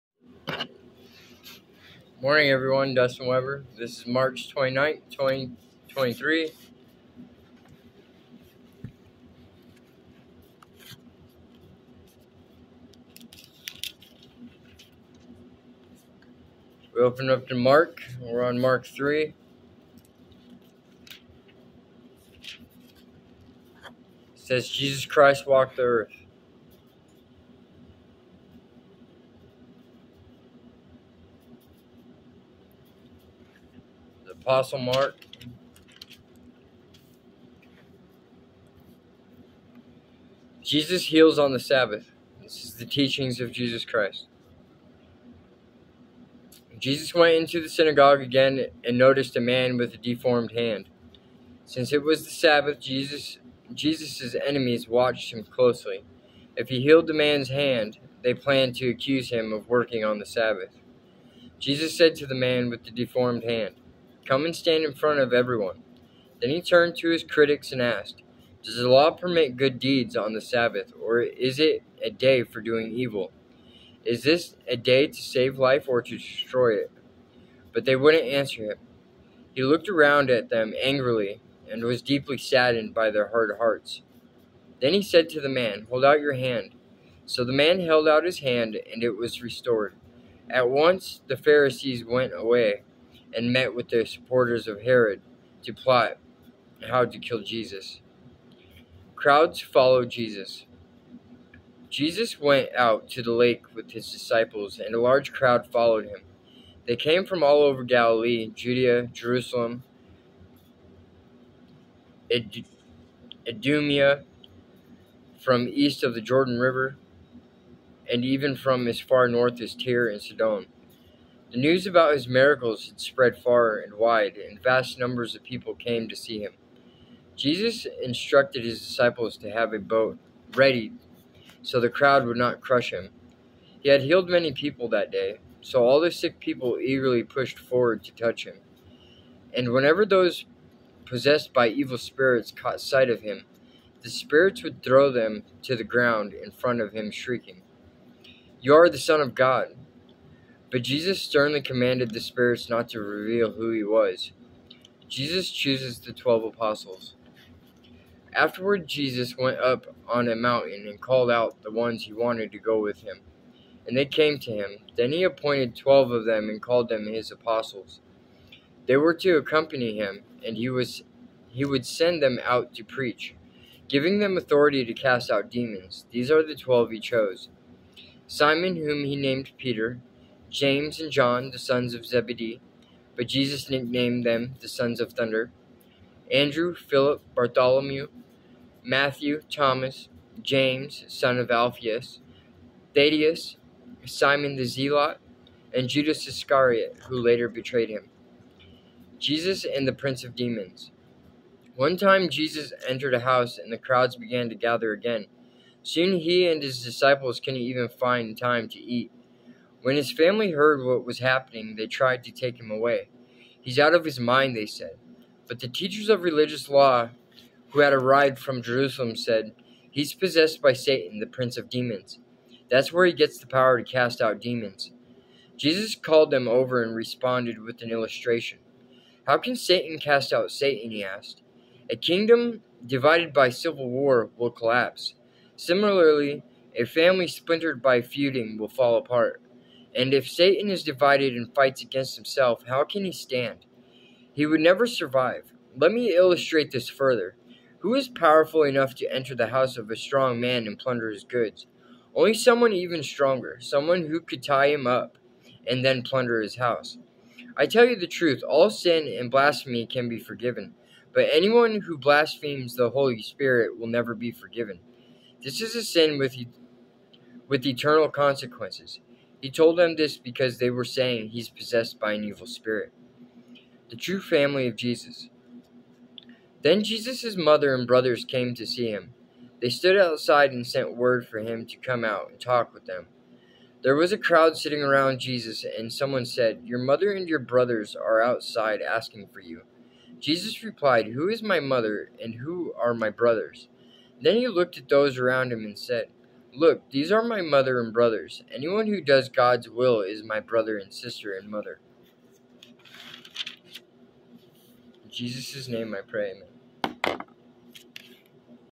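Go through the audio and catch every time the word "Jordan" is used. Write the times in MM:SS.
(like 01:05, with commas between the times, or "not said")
01:56.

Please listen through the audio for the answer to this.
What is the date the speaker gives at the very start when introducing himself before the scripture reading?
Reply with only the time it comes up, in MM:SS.
00:04.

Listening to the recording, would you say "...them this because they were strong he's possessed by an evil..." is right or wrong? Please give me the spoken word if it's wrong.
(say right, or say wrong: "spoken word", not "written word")
wrong: "saying", not "strong".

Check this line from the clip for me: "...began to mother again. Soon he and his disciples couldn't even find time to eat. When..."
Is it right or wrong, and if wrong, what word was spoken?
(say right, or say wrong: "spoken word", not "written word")
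wrong: "gather", not "mother".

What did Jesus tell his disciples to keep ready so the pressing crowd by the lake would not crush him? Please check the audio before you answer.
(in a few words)
A boat.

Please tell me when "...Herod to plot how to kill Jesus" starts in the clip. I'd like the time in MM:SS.
01:34.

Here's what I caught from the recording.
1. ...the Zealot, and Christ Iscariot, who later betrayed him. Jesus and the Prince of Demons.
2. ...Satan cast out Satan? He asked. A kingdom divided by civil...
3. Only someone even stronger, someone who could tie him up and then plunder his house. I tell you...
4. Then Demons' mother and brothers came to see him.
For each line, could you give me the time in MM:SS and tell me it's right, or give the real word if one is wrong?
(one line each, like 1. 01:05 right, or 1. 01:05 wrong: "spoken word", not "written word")
1. 03:14 wrong: "Judas", not "Christ"
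2. 03:49 right
3. 04:12 right
4. 04:36 wrong: "Jesus", not "Demons".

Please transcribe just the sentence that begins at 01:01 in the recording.
Jesus said to the man with the deformed hand, Come and stand in front of everyone.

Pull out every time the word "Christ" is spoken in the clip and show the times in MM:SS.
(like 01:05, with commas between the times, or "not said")
00:25, 00:43.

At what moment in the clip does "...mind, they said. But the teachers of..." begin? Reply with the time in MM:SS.
03:34.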